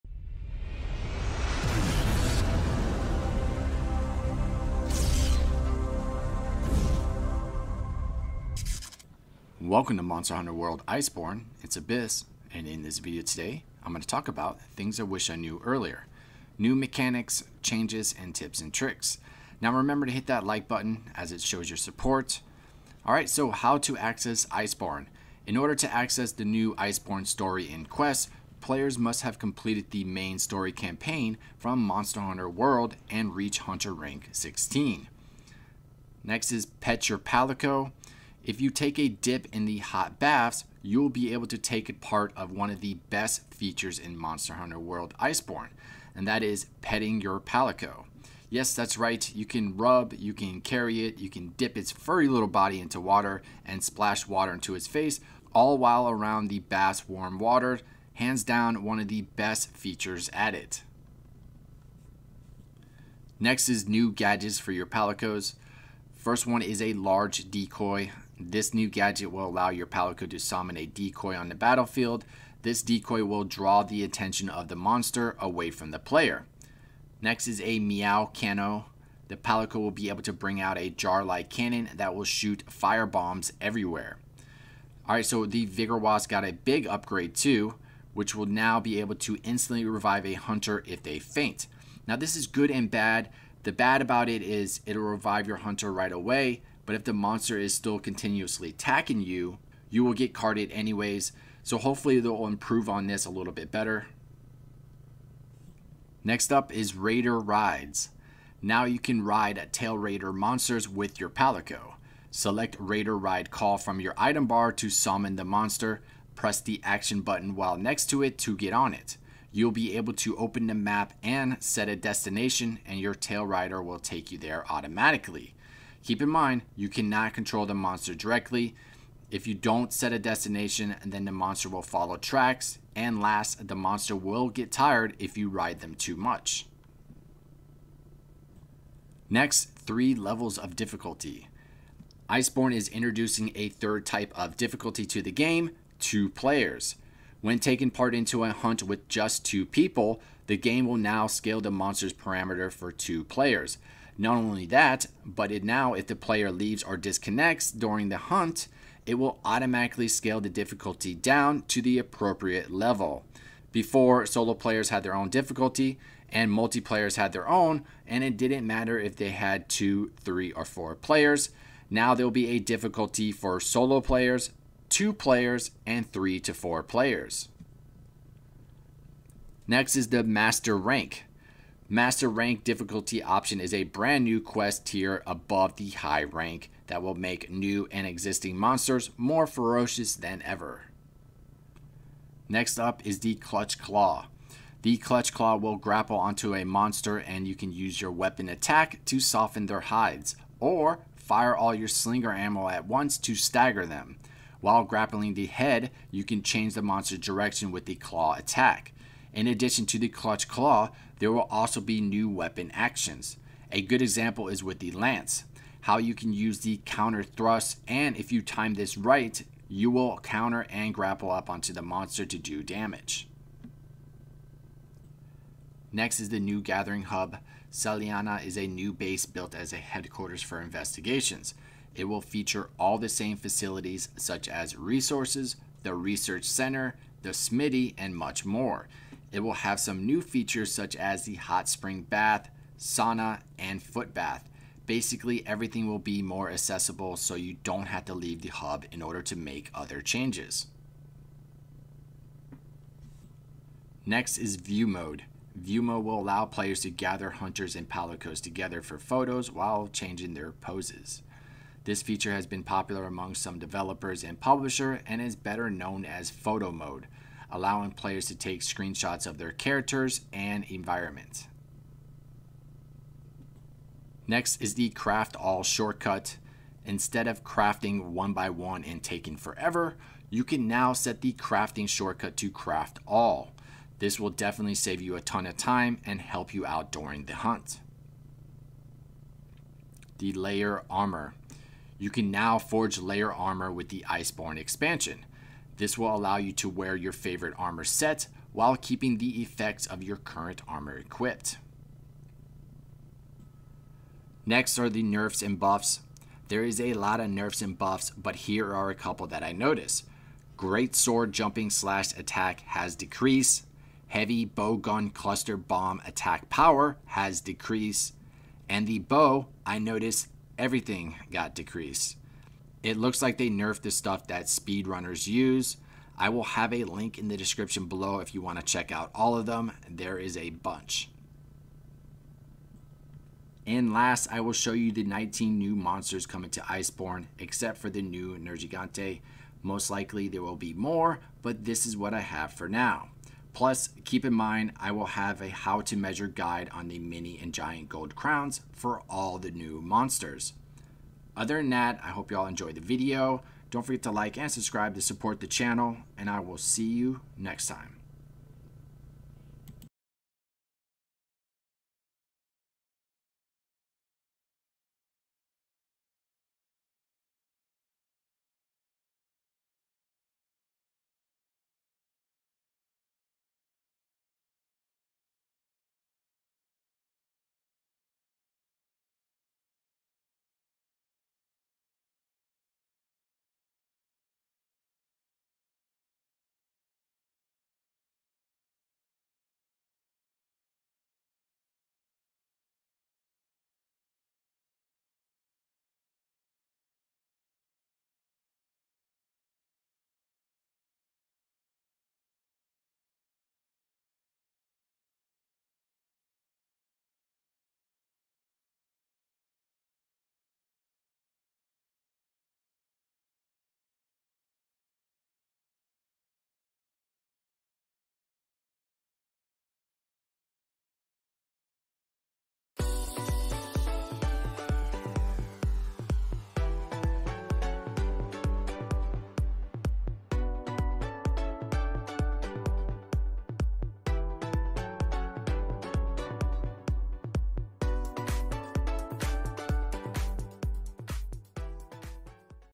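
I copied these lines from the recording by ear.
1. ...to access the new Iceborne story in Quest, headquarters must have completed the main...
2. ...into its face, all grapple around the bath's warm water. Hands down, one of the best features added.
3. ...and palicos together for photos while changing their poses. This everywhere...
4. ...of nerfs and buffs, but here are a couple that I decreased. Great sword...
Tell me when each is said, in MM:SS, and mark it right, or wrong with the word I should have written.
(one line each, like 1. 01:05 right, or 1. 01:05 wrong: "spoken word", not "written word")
1. 00:25 wrong: "players", not "headquarters"
2. 00:54 wrong: "while", not "grapple"
3. 04:17 wrong: "feature", not "everywhere"
4. 05:07 wrong: "noticed", not "decreased".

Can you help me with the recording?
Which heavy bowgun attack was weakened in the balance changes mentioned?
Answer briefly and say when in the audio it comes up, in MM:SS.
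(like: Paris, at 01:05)
Cluster bomb, at 05:15.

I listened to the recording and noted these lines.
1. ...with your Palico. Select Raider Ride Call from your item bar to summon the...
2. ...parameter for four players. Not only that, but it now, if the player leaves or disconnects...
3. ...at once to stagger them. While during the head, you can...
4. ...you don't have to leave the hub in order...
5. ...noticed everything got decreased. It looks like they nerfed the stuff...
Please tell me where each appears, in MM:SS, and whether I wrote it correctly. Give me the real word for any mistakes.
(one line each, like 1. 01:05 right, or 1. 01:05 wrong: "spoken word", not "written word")
1. 01:50 right
2. 02:32 wrong: "two", not "four"
3. 03:22 wrong: "grappling", not "during"
4. 04:07 right
5. 05:19 right.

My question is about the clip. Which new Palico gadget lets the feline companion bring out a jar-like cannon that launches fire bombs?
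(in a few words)
Meow Cano.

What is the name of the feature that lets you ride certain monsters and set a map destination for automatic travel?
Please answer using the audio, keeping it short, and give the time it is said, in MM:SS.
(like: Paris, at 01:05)
Raider Rides, at 01:46.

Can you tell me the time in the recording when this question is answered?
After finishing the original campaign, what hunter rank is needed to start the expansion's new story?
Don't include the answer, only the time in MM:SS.
00:33.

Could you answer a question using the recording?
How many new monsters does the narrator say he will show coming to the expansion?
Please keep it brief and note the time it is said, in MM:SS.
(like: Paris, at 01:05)
19, at 05:35.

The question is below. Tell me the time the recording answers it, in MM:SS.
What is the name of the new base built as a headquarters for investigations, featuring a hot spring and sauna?
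03:47.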